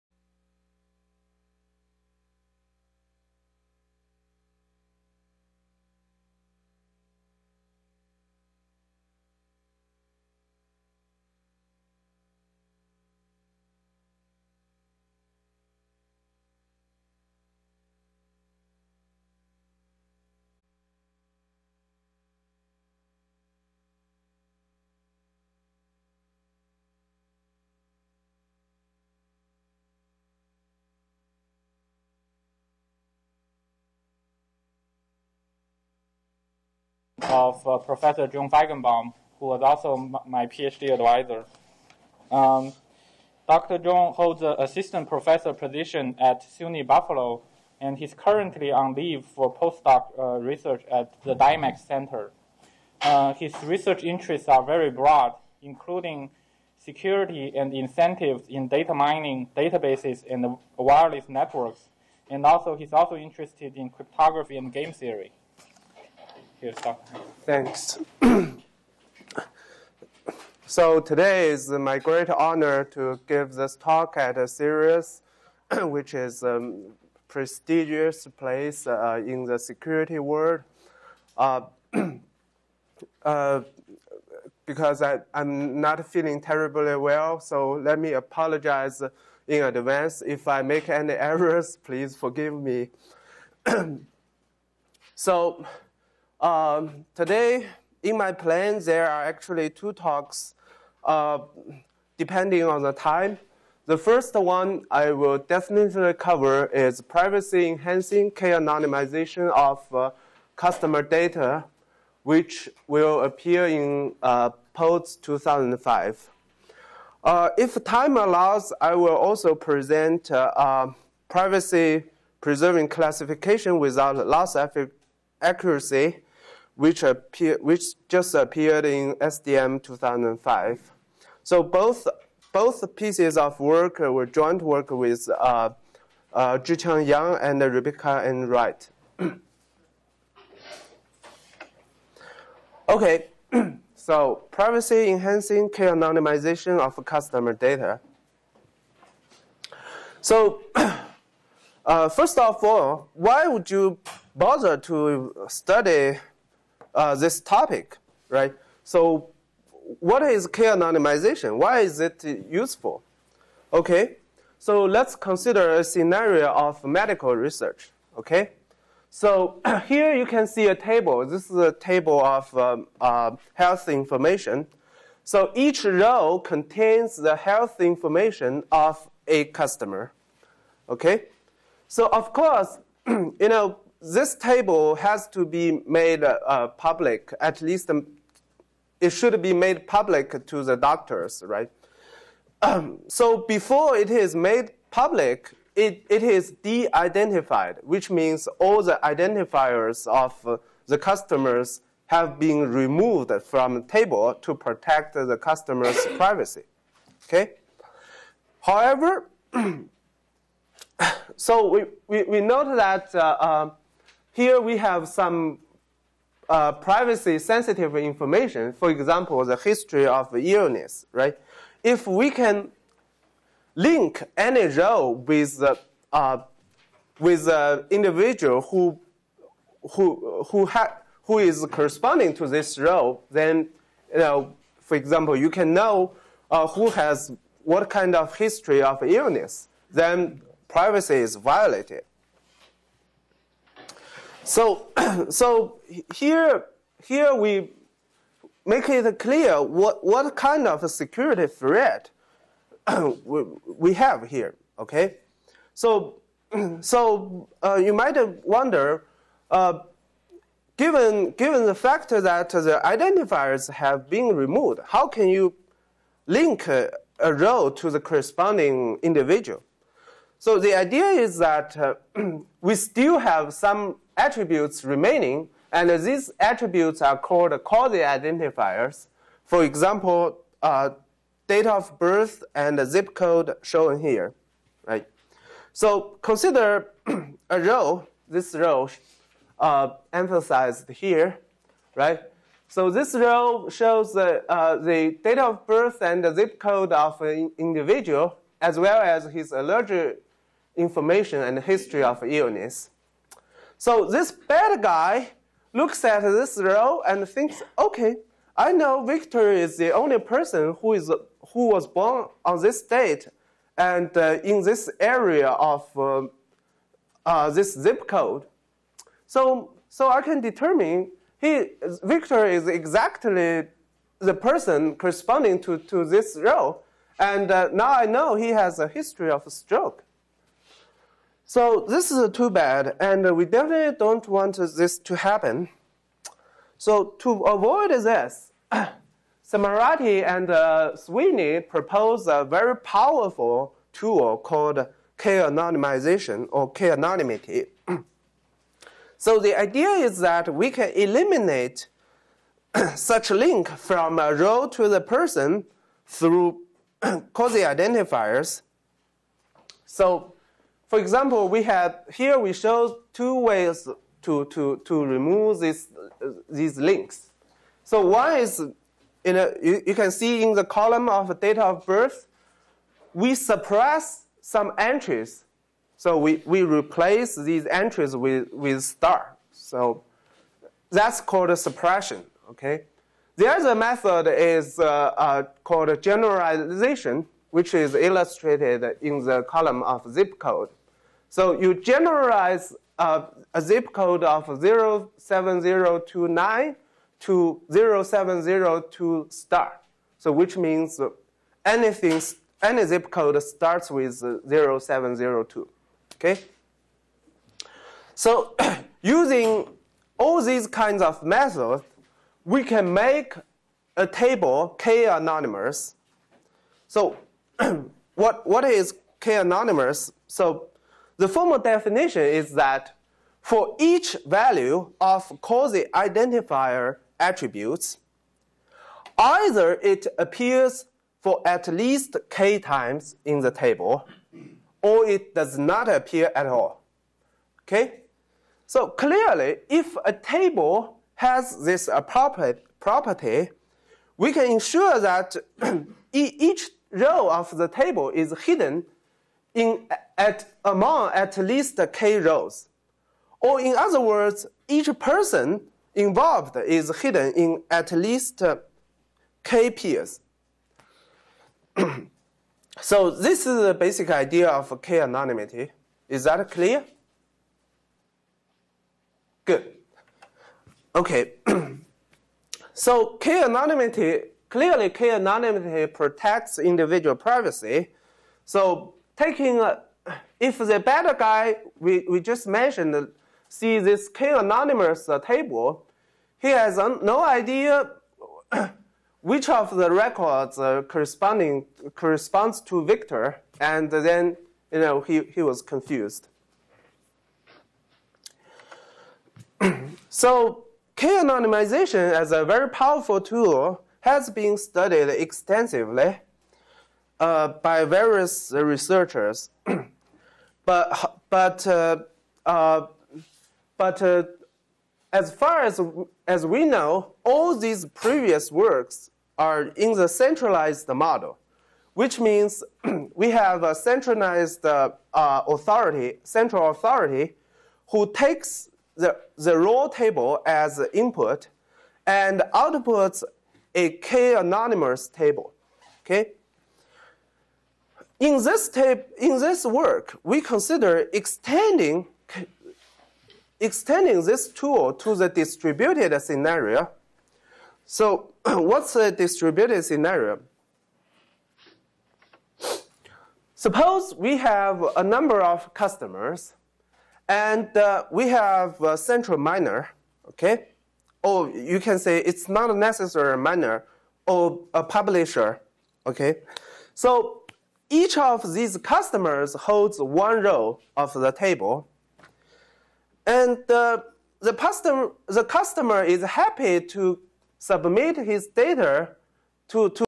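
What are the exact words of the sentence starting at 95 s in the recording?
so, um, today, in my plan, there are actually two talks, uh, depending on the time.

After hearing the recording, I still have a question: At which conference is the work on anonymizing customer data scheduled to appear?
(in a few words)
PODS 2005.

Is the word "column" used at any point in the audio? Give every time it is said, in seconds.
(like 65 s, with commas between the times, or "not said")
370 s, 389 s.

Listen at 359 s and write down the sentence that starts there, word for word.
So for example, we have here we show two ways to, to, to remove this, uh, these links.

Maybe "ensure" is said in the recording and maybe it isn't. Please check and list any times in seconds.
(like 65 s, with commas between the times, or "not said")
444 s.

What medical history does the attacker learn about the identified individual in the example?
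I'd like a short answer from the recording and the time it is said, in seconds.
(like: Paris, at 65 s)
stroke, at 329 s.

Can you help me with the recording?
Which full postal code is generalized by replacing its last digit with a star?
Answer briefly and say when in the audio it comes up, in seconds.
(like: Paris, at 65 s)
07029, at 395 s.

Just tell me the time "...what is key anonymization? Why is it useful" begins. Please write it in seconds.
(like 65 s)
159 s.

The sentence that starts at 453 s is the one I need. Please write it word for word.
Or in other words, each person involved is hidden in at least uh, k peers.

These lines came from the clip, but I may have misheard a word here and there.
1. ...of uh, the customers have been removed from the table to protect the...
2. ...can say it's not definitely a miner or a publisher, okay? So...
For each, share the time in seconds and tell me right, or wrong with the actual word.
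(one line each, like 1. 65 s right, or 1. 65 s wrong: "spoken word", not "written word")
1. 200 s right
2. 561 s wrong: "necessarily", not "definitely".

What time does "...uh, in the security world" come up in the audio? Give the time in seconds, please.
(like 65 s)
78 s.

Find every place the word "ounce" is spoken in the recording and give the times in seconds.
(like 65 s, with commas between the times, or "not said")
not said.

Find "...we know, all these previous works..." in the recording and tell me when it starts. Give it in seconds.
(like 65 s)
516 s.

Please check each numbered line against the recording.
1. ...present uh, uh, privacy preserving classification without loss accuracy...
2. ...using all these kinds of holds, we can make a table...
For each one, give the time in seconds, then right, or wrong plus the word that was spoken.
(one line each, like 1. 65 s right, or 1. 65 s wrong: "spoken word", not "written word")
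1. 119 s right
2. 409 s wrong: "methods", not "holds".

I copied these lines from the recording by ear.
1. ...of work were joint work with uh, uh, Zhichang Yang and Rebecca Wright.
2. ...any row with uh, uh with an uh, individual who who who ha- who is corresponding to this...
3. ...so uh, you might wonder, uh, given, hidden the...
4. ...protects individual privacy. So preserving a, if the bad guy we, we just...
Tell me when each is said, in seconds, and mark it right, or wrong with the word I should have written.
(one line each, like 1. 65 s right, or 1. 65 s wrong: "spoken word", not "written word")
1. 133 s right
2. 224 s right
3. 256 s wrong: "given", not "hidden"
4. 475 s wrong: "taking", not "preserving".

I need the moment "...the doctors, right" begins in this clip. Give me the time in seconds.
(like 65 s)
190 s.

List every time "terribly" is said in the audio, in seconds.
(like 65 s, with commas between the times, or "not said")
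86 s.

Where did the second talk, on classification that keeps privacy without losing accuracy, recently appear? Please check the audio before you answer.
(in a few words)
SDM 2005.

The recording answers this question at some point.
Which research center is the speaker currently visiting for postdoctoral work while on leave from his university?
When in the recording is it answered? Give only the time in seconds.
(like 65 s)
51 s.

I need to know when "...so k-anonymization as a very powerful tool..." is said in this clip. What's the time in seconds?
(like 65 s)
500 s.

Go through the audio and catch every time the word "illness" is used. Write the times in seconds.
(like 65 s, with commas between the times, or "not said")
220 s, 239 s, 302 s.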